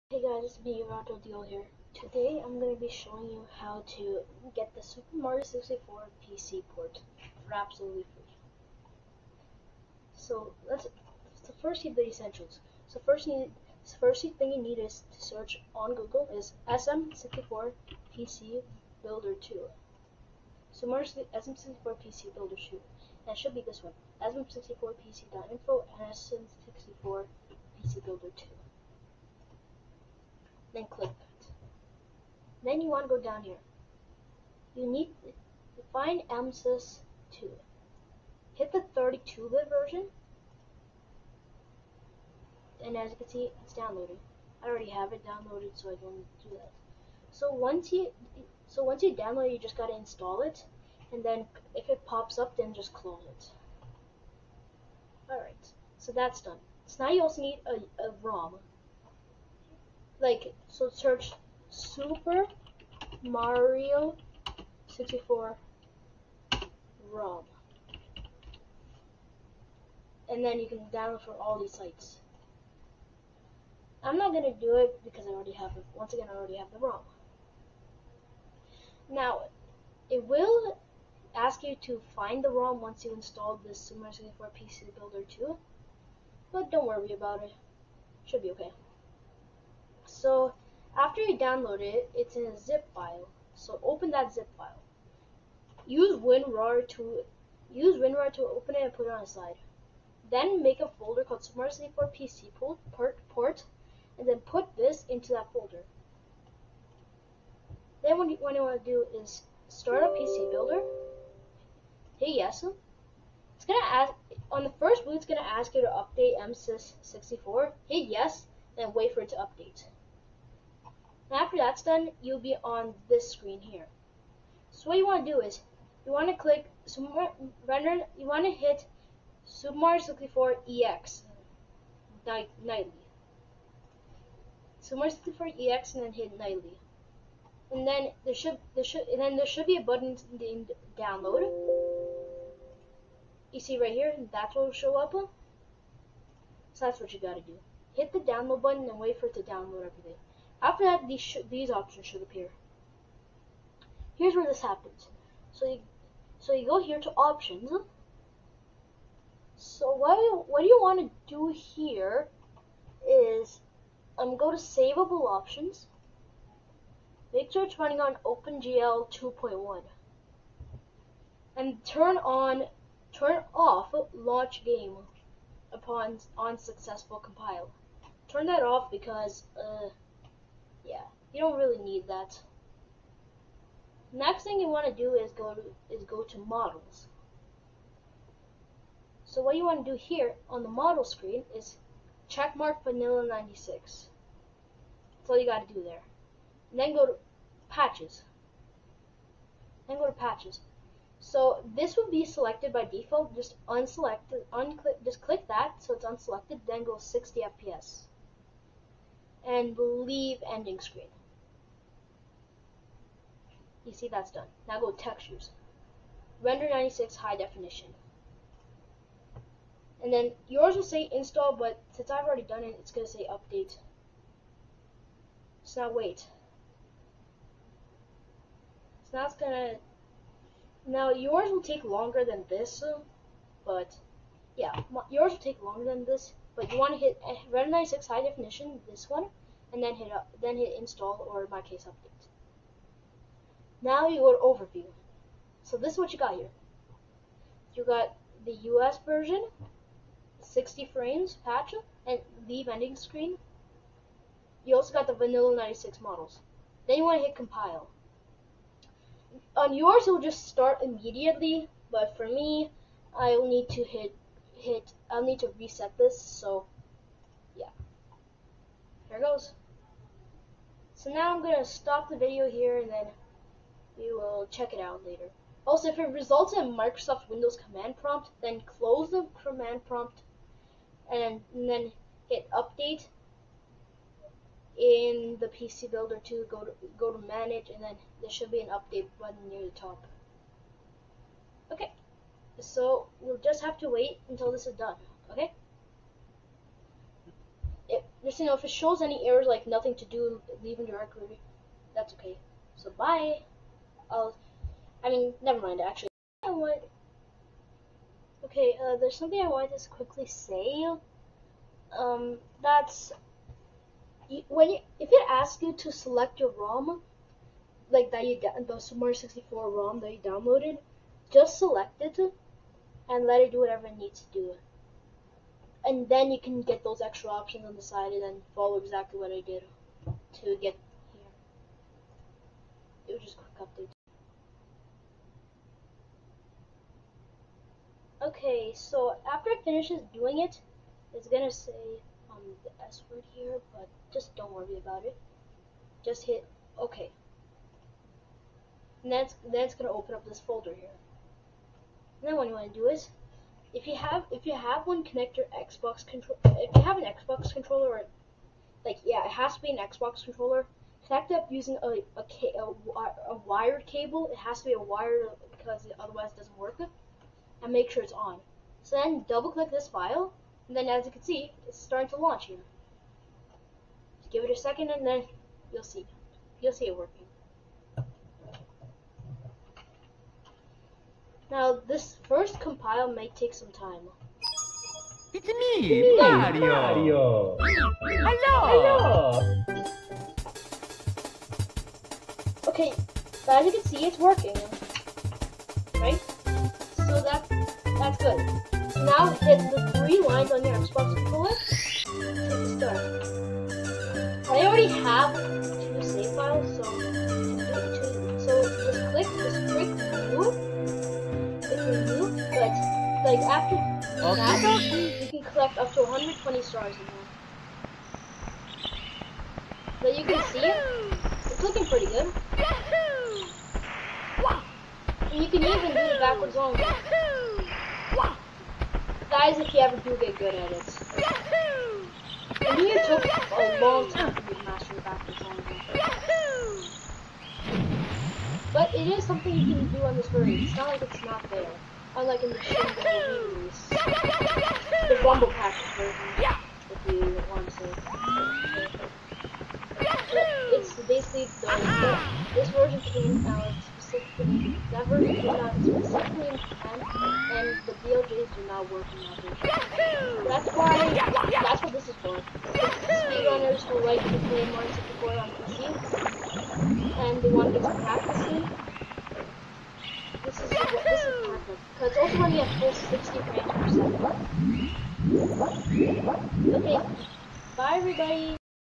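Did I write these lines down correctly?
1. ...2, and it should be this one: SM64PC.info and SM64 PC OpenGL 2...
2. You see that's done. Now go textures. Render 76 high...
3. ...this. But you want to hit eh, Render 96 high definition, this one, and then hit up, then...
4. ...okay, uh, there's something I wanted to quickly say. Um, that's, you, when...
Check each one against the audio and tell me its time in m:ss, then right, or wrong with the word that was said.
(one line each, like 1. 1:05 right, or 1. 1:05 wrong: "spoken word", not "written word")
1. 0:22 wrong: "Builder", not "OpenGL"
2. 3:33 wrong: "96", not "76"
3. 3:56 right
4. 5:08 right.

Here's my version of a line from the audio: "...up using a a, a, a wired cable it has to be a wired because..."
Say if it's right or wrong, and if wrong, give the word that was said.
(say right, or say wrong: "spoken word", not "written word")
right.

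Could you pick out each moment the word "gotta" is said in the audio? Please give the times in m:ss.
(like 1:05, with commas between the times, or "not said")
0:49, 2:27.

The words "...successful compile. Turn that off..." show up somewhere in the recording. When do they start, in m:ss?
2:56.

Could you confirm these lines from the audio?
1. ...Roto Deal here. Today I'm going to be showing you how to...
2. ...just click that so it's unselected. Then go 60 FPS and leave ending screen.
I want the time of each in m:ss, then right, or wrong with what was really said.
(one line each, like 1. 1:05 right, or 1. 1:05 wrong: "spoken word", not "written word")
1. 0:00 right
2. 3:25 right.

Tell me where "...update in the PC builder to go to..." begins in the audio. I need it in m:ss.
4:42.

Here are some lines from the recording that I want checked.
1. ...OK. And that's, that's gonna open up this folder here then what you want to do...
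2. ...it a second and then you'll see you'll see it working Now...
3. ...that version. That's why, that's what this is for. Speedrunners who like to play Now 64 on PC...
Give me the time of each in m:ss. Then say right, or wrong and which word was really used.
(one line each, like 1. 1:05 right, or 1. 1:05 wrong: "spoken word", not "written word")
1. 5:46 right
2. 6:14 right
3. 7:39 wrong: "Mario", not "Now".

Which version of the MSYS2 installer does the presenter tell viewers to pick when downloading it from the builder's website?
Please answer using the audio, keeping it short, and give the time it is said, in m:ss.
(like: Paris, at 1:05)
32-bit, at 0:38.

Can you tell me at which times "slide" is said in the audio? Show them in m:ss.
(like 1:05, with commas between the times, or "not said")
1:39.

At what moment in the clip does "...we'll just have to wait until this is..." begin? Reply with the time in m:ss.
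4:53.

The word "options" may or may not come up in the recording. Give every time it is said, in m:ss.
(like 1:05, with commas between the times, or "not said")
2:31, 2:37, 2:45, 5:27.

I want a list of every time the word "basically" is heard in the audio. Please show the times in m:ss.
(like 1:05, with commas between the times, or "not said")
7:31.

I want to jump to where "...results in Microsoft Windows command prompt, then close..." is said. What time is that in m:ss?
4:36.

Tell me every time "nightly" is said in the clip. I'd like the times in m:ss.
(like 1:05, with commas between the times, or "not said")
2:12, 2:16.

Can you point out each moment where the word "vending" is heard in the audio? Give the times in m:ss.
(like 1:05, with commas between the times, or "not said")
4:12.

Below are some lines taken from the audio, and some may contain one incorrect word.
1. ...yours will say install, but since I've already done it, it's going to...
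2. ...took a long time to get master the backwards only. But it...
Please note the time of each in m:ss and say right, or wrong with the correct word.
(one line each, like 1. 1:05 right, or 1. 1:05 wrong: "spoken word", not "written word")
1. 3:40 right
2. 7:13 right.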